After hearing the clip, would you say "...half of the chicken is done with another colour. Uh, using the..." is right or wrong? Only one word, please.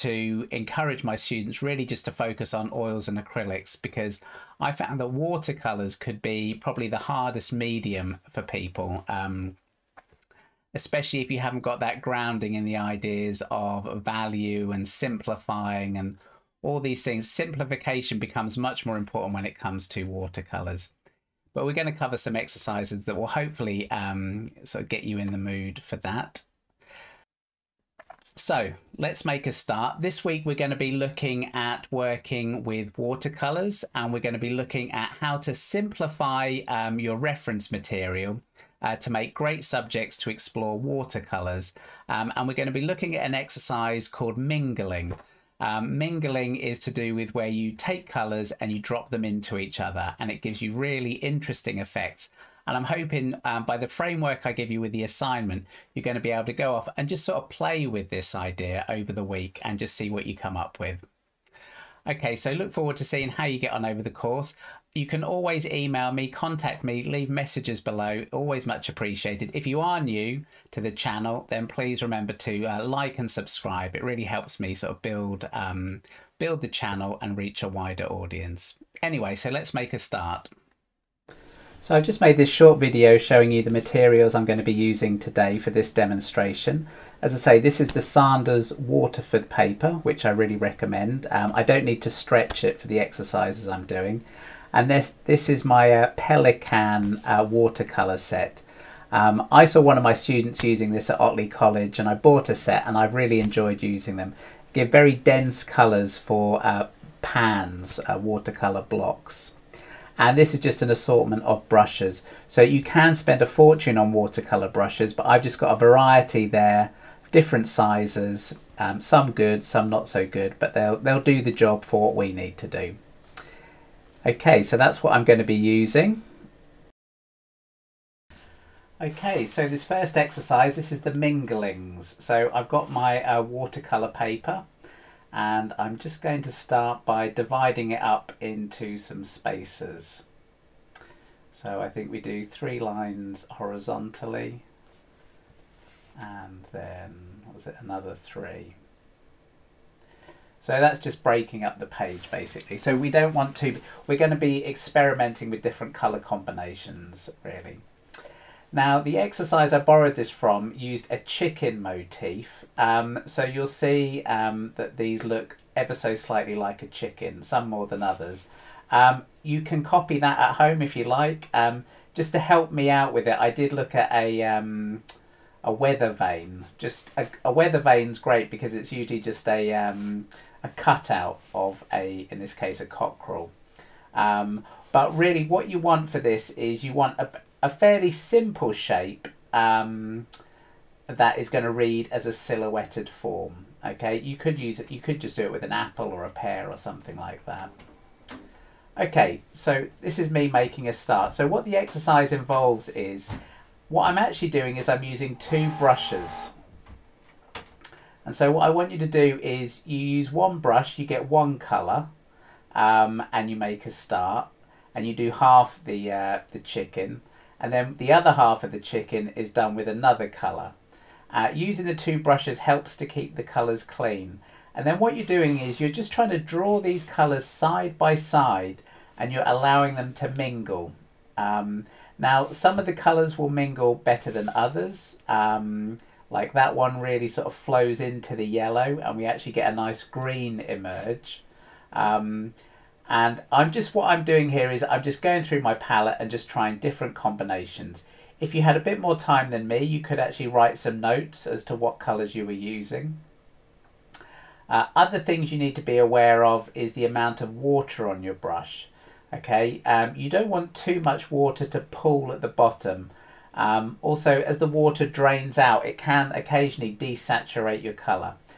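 right.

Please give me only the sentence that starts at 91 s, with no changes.
Um, I don't need to stretch it for the exercises I'm doing and this this is my uh, Pelikan uh, watercolor set.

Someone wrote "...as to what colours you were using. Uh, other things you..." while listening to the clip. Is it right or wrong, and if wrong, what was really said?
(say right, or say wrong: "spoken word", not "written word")
right.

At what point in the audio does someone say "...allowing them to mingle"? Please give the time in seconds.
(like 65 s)
229 s.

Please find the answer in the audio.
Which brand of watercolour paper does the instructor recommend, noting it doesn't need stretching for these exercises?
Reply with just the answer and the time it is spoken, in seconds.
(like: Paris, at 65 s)
Saunders Waterford, at 88 s.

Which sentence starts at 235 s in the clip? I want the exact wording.
Um, like that one really sort of flows into the yellow and we actually get a nice green emerge.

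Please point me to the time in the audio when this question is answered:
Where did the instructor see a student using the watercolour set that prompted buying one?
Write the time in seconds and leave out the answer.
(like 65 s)
101 s.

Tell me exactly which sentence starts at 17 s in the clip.
Simplification becomes much more important when it comes to watercolors.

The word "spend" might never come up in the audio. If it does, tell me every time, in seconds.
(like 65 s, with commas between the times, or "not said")
113 s.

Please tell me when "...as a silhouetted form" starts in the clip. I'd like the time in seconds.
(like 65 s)
192 s.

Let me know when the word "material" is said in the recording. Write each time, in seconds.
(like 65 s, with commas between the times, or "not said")
37 s, 83 s.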